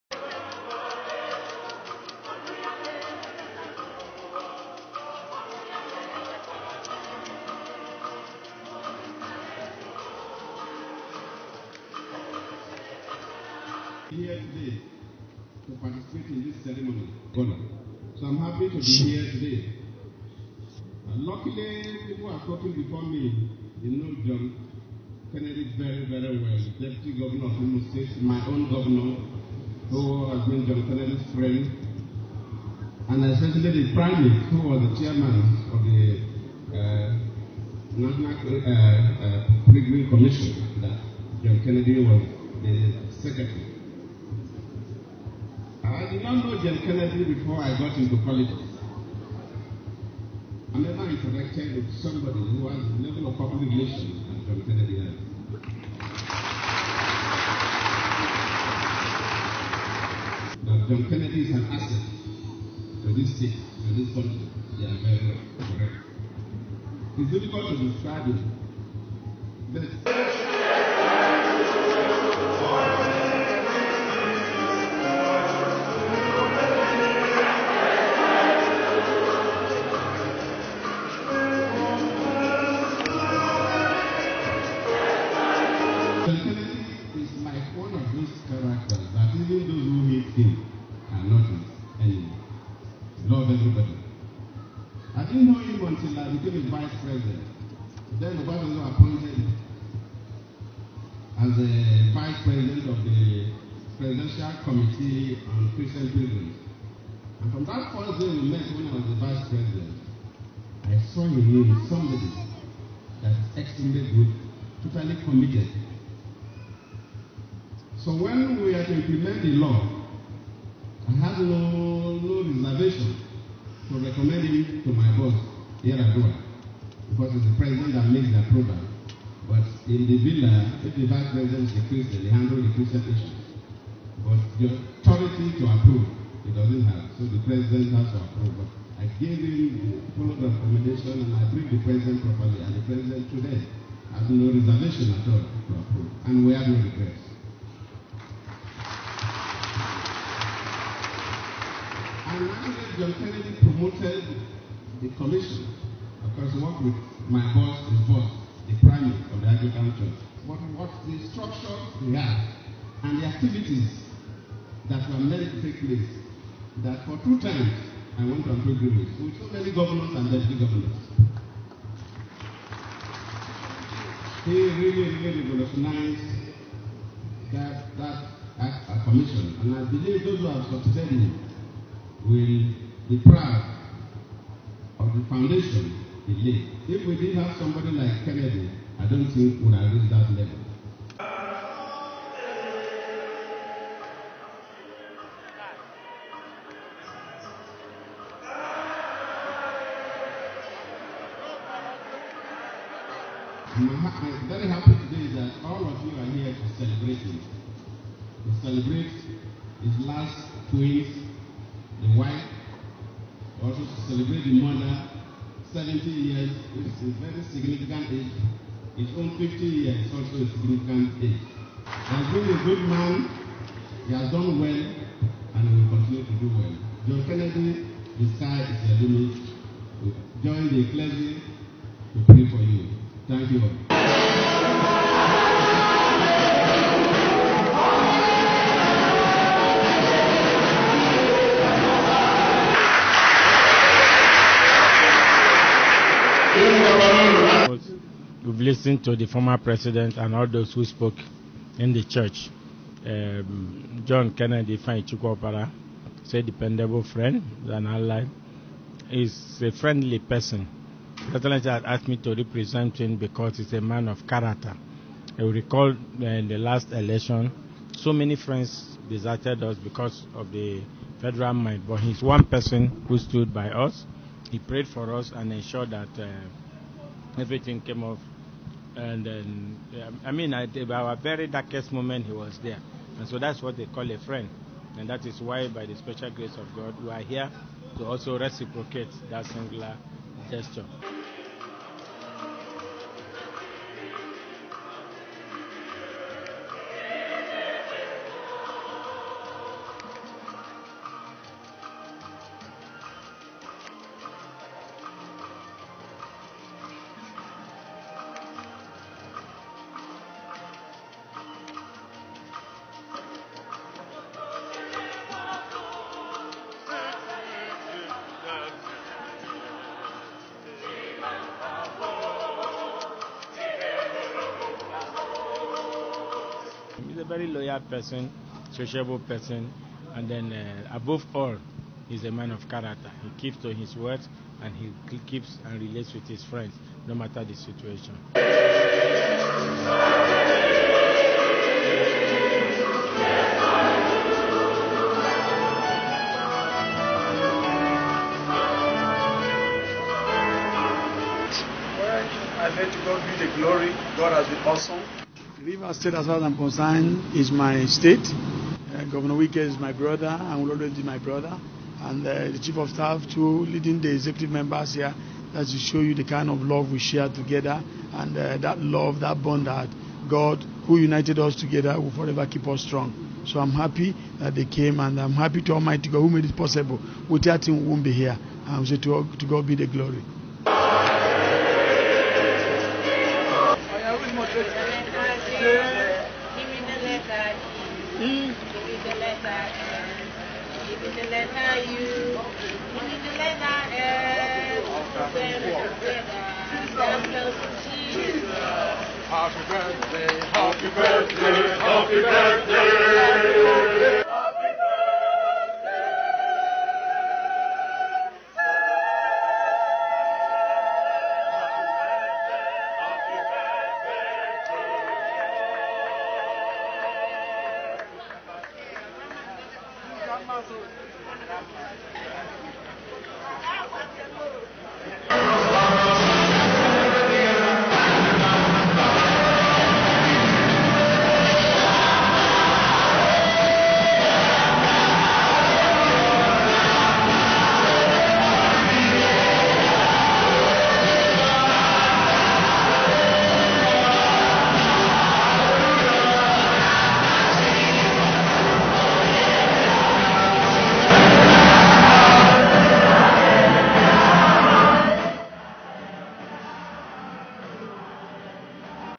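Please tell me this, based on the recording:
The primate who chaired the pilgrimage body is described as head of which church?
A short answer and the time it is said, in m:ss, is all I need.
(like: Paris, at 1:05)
Anglican Church, at 2:39.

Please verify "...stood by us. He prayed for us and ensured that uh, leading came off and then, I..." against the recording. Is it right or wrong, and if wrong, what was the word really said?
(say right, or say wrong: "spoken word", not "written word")
wrong: "everything", not "leading".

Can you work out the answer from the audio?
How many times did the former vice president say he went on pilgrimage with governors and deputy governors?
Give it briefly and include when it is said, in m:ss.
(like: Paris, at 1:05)
2, at 2:47.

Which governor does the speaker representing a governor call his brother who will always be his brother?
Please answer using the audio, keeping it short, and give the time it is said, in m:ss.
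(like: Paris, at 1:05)
Wike, at 5:59.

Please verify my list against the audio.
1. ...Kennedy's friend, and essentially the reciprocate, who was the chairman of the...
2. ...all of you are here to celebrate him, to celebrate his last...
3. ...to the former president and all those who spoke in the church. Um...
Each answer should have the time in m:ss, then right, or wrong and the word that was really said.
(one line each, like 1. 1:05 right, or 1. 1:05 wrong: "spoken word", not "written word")
1. 0:30 wrong: "primate", not "reciprocate"
2. 3:25 right
3. 4:09 right.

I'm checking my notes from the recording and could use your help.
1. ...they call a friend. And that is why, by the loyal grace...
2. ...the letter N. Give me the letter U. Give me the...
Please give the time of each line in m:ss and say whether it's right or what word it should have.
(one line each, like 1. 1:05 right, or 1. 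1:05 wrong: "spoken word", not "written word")
1. 4:43 wrong: "special", not "loyal"
2. 6:29 right.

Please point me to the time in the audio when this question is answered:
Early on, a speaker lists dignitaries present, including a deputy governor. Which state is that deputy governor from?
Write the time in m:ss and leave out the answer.
0:27.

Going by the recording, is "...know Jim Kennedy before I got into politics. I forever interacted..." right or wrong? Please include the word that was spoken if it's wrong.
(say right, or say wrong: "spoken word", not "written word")
wrong: "never", not "forever".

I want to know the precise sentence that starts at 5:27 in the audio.
very loyal person, sociable person, and then uh, above all, he's a man of character.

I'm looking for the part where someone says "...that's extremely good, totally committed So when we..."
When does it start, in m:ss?
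1:53.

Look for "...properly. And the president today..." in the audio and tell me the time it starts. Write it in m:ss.
2:22.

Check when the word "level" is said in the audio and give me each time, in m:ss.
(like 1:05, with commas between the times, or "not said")
0:53, 3:10.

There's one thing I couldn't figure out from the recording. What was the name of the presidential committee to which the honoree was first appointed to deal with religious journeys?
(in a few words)
Presidential Committee on Christian Pilgrims.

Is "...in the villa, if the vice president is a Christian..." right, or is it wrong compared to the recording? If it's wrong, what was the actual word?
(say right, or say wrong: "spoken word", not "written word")
right.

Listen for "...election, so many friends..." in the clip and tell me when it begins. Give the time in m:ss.
4:26.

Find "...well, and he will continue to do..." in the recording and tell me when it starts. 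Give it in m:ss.
3:44.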